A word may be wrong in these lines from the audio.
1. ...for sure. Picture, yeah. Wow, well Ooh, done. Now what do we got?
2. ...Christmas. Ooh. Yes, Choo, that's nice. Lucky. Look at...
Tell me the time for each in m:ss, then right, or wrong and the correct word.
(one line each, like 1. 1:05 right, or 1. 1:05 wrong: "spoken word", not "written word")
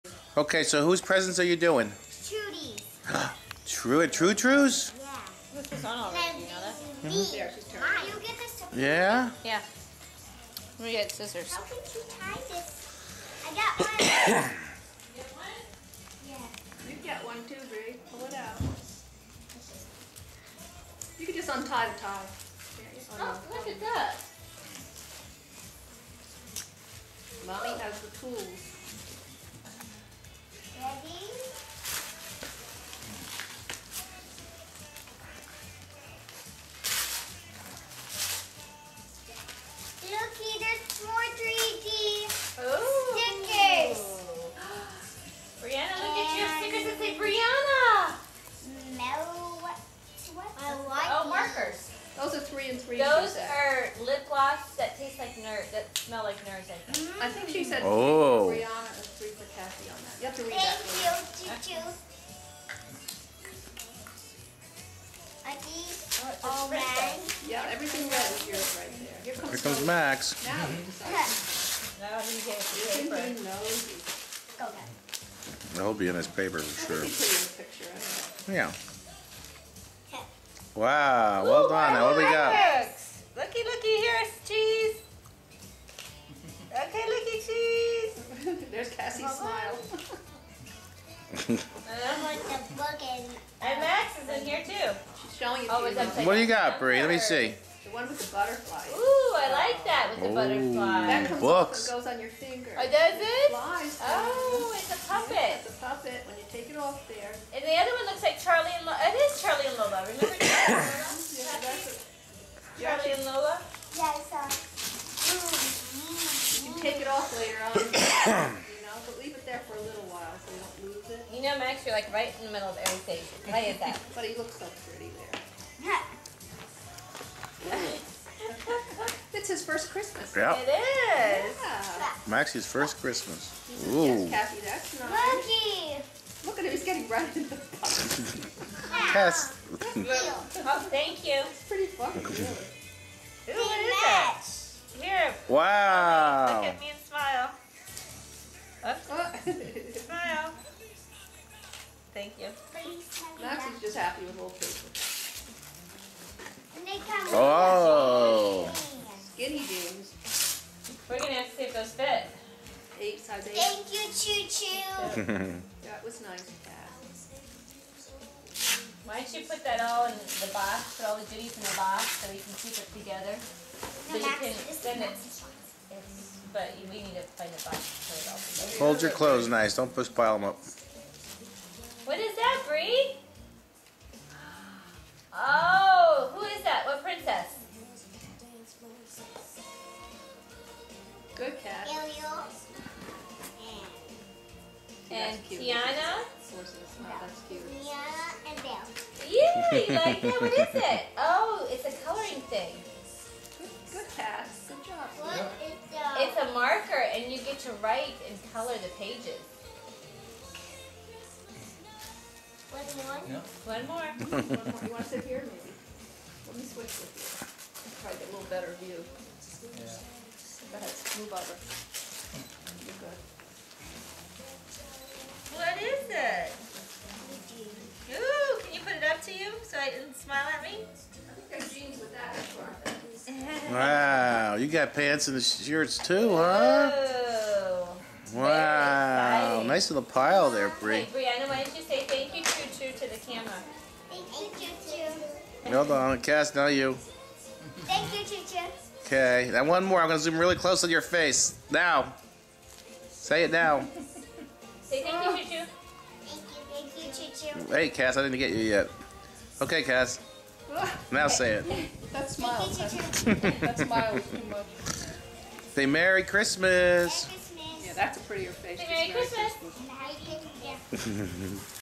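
1. 1:16 right
2. 2:12 wrong: "Kathy", not "Choo".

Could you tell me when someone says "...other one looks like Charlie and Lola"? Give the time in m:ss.
1:47.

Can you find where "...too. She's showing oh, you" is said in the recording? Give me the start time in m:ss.
1:34.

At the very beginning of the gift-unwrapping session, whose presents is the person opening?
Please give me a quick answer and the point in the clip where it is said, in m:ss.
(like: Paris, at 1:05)
Trudy's, at 0:02.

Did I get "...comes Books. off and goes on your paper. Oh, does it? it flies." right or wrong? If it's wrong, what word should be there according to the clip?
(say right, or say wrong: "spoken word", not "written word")
wrong: "finger", not "paper".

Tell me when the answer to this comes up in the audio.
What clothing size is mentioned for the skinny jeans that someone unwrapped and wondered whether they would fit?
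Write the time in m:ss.
2:42.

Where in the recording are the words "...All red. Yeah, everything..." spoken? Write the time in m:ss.
1:06.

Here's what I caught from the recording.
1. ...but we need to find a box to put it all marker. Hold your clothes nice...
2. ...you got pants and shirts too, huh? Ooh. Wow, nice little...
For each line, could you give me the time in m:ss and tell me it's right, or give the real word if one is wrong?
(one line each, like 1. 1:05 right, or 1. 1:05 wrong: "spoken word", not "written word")
1. 2:56 wrong: "together", not "marker"
2. 3:54 right.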